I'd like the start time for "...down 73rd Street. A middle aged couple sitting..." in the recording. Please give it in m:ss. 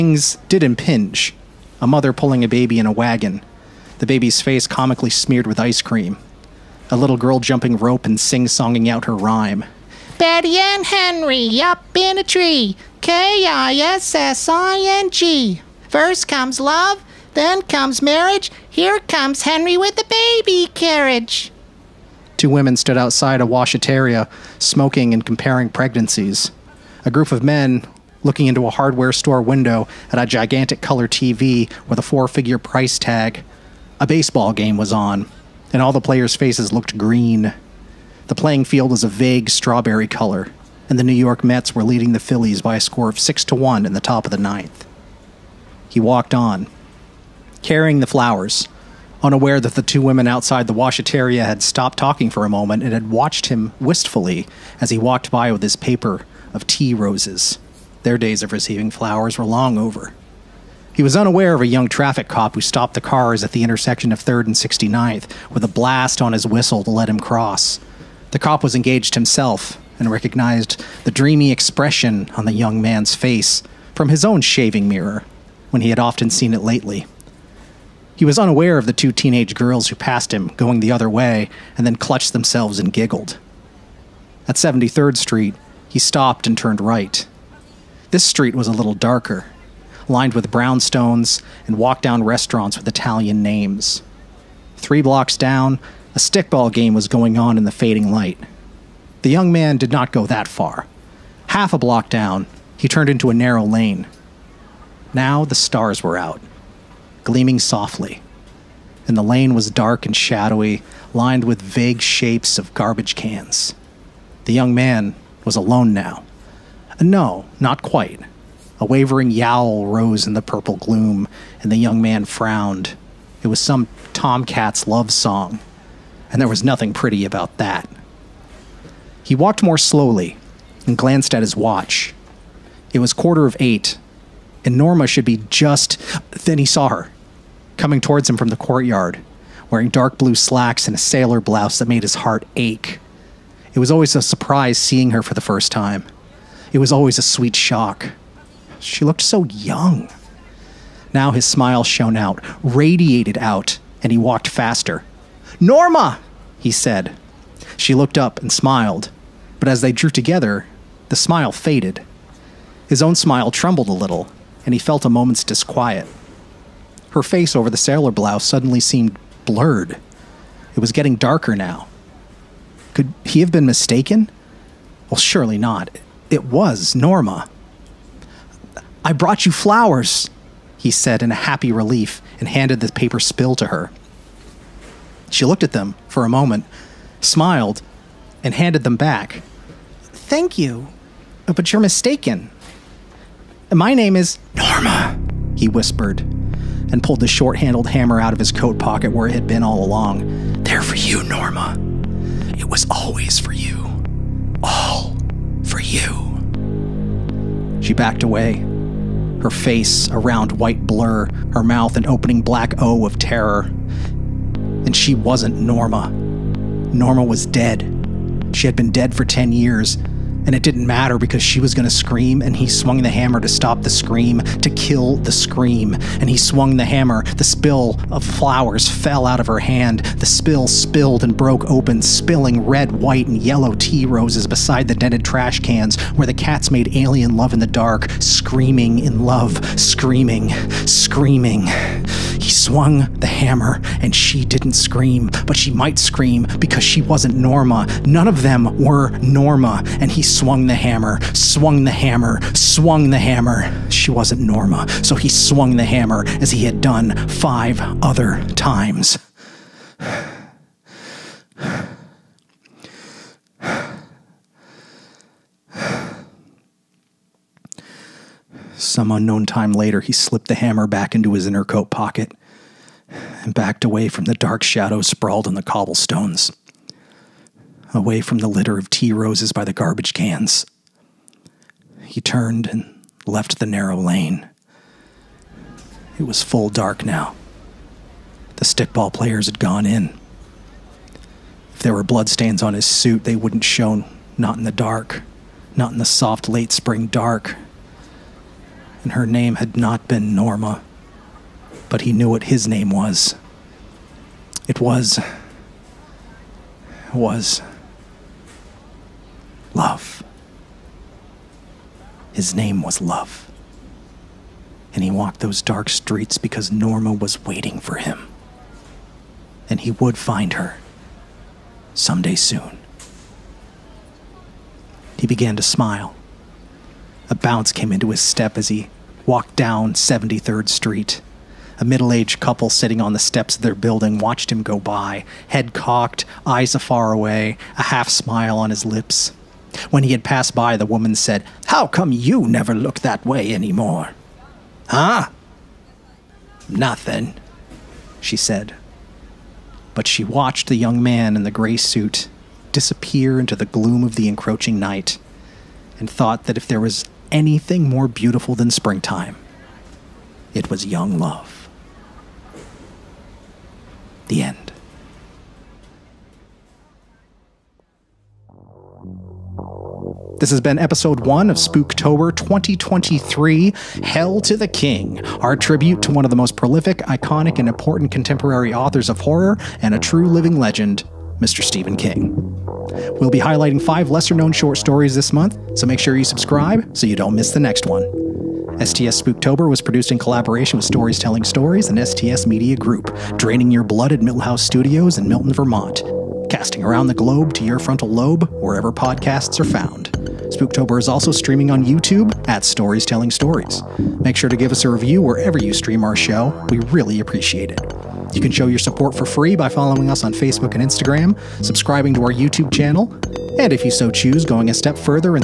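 5:29.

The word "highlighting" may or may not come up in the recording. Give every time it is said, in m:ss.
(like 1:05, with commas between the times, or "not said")
6:23.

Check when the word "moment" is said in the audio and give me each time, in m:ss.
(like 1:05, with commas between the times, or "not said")
0:52, 2:45, 3:06.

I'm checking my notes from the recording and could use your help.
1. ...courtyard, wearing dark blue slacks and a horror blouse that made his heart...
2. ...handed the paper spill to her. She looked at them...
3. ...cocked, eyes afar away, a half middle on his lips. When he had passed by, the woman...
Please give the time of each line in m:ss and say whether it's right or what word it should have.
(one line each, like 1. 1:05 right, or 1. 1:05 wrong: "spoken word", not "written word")
1. 2:18 wrong: "sailor", not "horror"
2. 3:02 right
3. 5:35 wrong: "smile", not "middle".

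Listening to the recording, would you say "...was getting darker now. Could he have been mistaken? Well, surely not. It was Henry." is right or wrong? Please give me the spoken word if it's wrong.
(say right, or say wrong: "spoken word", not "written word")
wrong: "Norma", not "Henry".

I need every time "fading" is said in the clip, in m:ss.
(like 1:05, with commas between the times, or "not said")
1:37.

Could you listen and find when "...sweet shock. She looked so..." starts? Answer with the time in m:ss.
2:27.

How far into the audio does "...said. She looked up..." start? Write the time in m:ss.
2:36.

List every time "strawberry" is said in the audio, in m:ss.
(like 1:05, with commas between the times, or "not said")
0:39.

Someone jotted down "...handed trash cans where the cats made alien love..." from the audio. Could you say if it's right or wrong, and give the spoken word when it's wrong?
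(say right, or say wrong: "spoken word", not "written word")
wrong: "dented", not "handed".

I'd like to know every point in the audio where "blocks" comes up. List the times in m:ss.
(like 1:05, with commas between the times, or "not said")
1:35, 1:41.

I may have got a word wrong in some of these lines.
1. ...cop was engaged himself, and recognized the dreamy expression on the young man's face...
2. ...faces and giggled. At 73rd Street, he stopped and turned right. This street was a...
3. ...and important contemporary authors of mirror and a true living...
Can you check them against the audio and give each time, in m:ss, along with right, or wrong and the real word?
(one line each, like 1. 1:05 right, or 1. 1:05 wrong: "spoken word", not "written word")
1. 1:08 right
2. 1:22 wrong: "themselves", not "faces"
3. 6:17 wrong: "horror", not "mirror".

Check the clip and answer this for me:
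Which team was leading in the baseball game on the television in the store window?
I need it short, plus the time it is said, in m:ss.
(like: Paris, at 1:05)
New York Mets, at 0:41.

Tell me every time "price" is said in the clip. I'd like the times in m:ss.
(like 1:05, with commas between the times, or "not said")
0:32.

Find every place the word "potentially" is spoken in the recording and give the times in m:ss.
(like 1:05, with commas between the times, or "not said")
not said.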